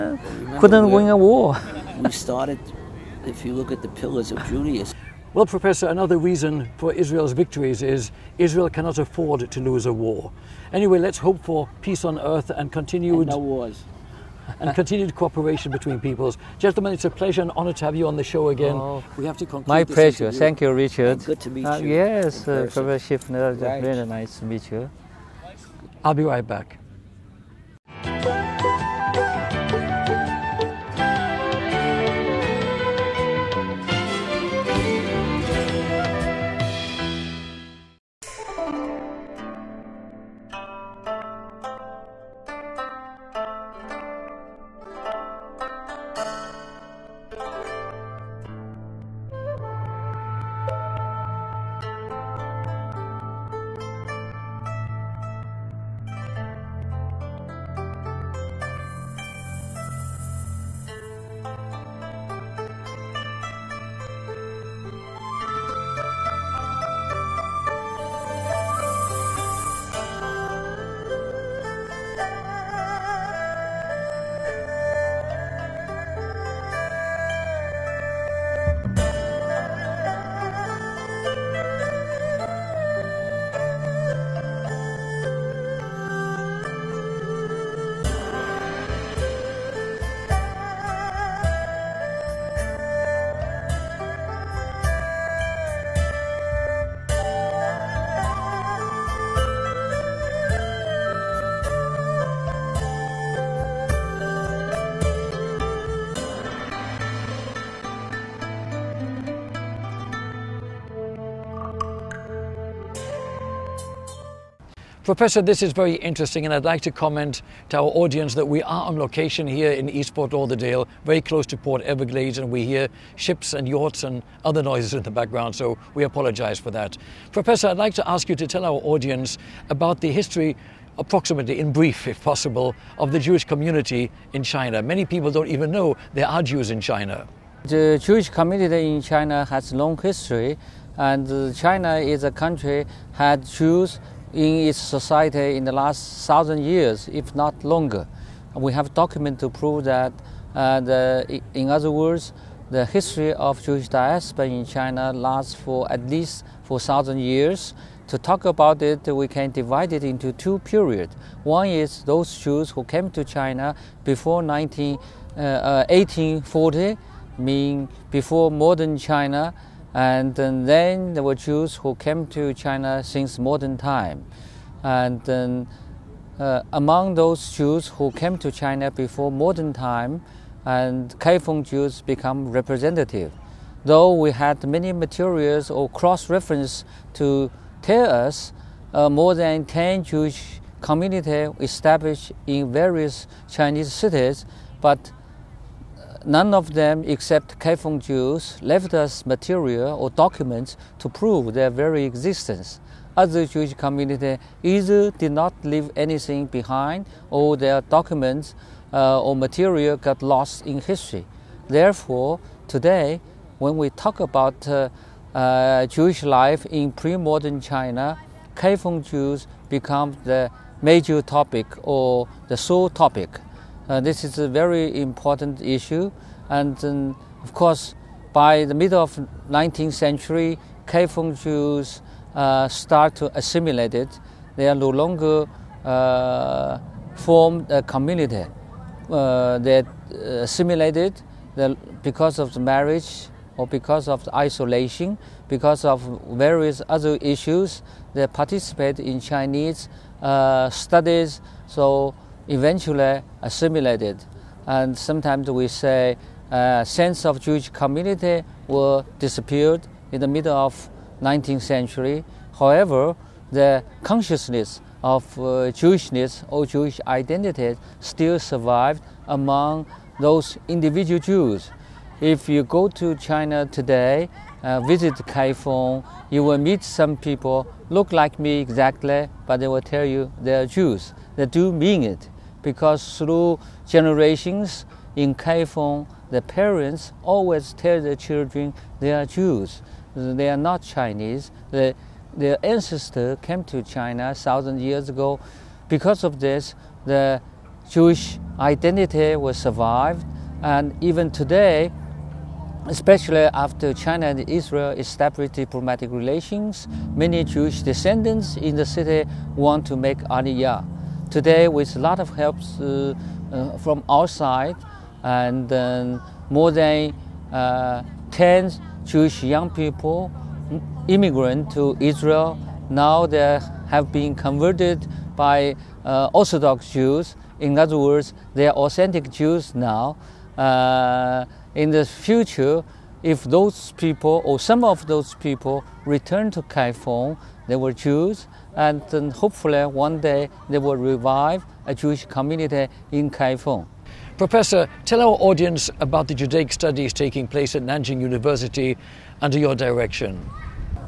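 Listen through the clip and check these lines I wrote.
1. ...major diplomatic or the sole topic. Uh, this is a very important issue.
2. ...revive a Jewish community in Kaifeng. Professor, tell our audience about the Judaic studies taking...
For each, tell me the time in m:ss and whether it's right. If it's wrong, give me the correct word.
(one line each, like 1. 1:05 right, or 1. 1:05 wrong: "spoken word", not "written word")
1. 3:40 wrong: "topic", not "diplomatic"
2. 5:40 right.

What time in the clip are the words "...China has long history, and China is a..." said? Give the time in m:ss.
2:19.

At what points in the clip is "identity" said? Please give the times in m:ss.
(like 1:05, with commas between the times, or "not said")
4:27, 4:58.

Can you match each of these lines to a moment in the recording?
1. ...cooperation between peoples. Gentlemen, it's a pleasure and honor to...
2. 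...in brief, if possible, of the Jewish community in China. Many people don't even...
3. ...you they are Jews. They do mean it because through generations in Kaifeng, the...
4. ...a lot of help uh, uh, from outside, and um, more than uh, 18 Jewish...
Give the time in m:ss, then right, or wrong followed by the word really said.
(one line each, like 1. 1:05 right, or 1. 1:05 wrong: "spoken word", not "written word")
1. 0:15 right
2. 2:11 right
3. 4:40 right
4. 5:11 wrong: "10", not "18".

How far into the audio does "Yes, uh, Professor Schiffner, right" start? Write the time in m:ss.
0:21.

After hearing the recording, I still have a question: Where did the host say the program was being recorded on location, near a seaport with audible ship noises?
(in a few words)
Eastport Lauderdale.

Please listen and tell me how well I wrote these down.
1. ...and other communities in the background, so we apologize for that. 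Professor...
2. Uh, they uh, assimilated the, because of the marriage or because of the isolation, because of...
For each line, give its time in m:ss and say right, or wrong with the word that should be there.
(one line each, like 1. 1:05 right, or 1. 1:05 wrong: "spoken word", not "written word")
1. 2:04 wrong: "noises", not "communities"
2. 3:59 right.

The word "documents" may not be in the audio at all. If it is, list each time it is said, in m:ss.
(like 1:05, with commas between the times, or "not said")
2:28, 3:20, 3:27.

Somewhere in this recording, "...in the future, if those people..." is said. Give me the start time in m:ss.
5:31.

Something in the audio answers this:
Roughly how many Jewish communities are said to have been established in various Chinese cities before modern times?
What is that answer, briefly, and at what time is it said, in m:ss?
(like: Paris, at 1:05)
More than 10, at 3:09.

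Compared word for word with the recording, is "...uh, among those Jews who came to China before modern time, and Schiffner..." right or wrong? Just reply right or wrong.
wrong.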